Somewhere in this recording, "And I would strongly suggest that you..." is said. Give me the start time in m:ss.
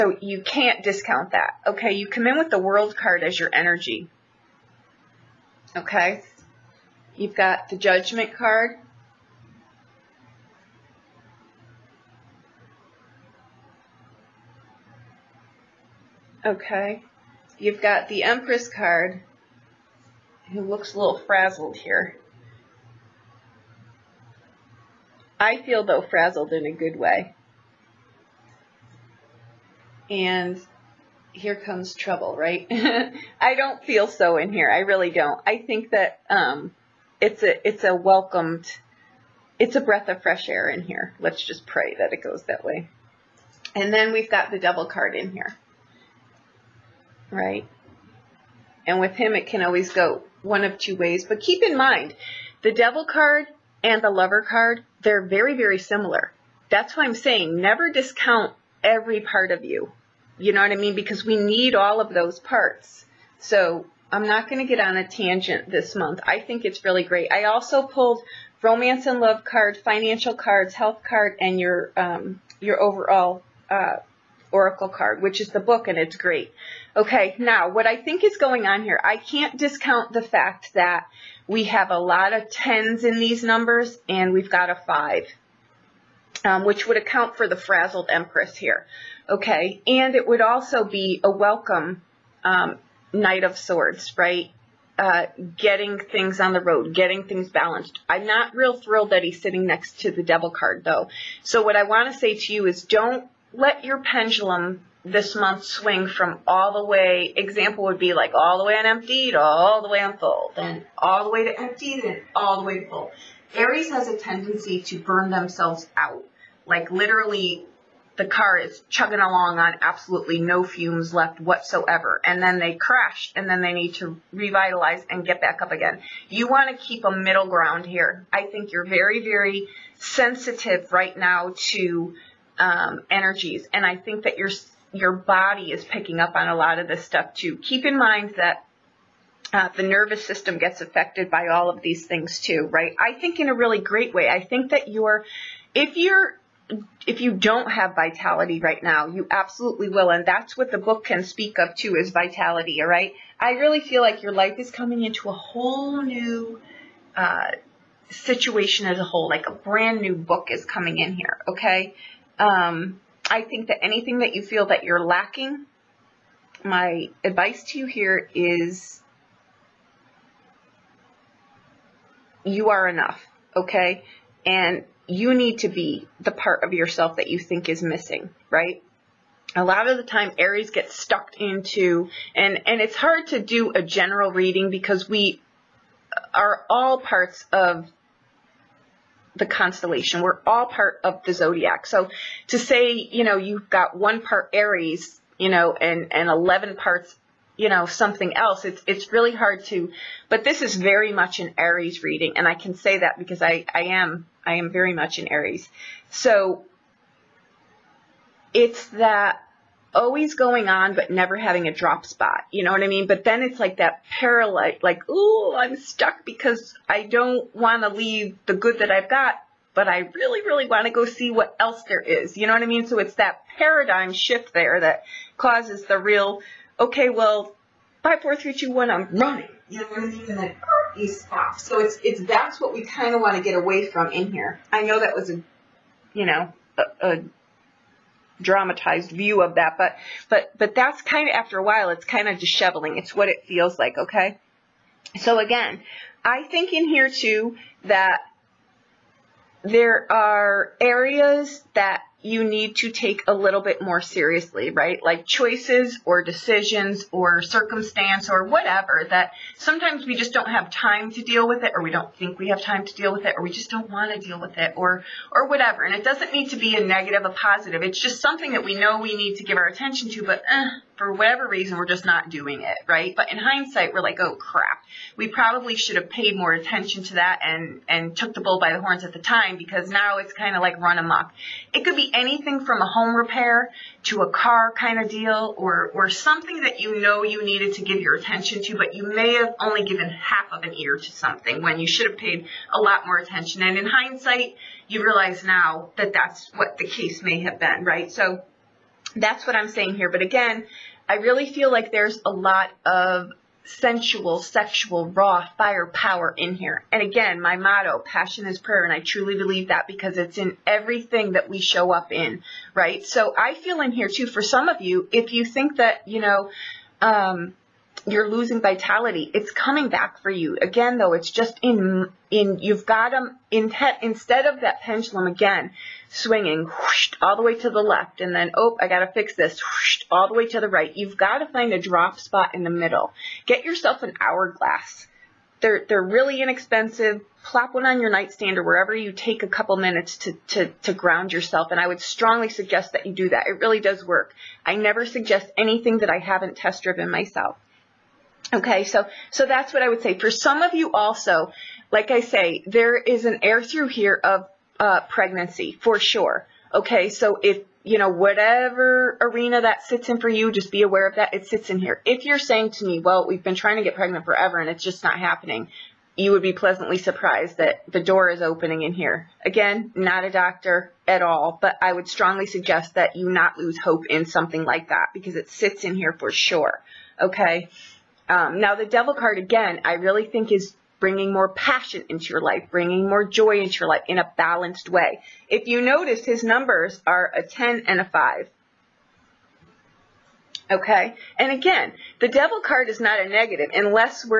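5:41.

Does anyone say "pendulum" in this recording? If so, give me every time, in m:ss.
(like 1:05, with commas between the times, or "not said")
1:43, 5:24.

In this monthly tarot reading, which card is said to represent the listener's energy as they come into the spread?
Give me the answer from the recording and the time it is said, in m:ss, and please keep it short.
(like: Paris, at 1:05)
The World card, at 0:02.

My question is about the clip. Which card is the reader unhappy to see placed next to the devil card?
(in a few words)
Knight of Swords.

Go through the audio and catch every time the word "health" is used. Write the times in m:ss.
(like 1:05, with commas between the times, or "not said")
1:10.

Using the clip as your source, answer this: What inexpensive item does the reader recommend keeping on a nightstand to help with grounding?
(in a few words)
An hourglass.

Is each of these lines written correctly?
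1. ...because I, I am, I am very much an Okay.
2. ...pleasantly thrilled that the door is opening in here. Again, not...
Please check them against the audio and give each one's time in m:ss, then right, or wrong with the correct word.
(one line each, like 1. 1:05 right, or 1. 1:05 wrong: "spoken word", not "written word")
1. 3:23 wrong: "Aries", not "Okay"
2. 6:06 wrong: "surprised", not "thrilled".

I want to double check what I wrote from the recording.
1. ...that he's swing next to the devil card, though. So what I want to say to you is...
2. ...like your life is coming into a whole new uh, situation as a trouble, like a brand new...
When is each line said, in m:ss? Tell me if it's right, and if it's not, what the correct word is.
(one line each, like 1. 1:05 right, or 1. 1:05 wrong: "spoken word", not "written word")
1. 1:39 wrong: "sitting", not "swing"
2. 2:34 wrong: "whole", not "trouble".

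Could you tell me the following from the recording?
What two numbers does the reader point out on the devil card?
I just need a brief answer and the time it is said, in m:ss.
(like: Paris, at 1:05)
10 and 5, at 6:27.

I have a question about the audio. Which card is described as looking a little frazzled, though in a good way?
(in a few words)
The Empress.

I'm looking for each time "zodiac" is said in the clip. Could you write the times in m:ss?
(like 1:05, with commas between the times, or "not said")
3:11.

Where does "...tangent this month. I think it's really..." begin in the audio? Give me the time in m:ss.
1:05.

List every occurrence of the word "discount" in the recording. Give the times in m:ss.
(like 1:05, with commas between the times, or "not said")
0:00, 0:57, 1:19.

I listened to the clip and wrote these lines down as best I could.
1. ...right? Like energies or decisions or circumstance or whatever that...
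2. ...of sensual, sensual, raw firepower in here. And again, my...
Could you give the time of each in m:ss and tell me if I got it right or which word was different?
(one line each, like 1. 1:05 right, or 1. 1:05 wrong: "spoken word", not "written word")
1. 4:14 wrong: "choices", not "energies"
2. 5:02 wrong: "sexual", not "sensual".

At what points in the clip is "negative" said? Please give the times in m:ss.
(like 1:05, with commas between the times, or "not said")
4:26, 6:33.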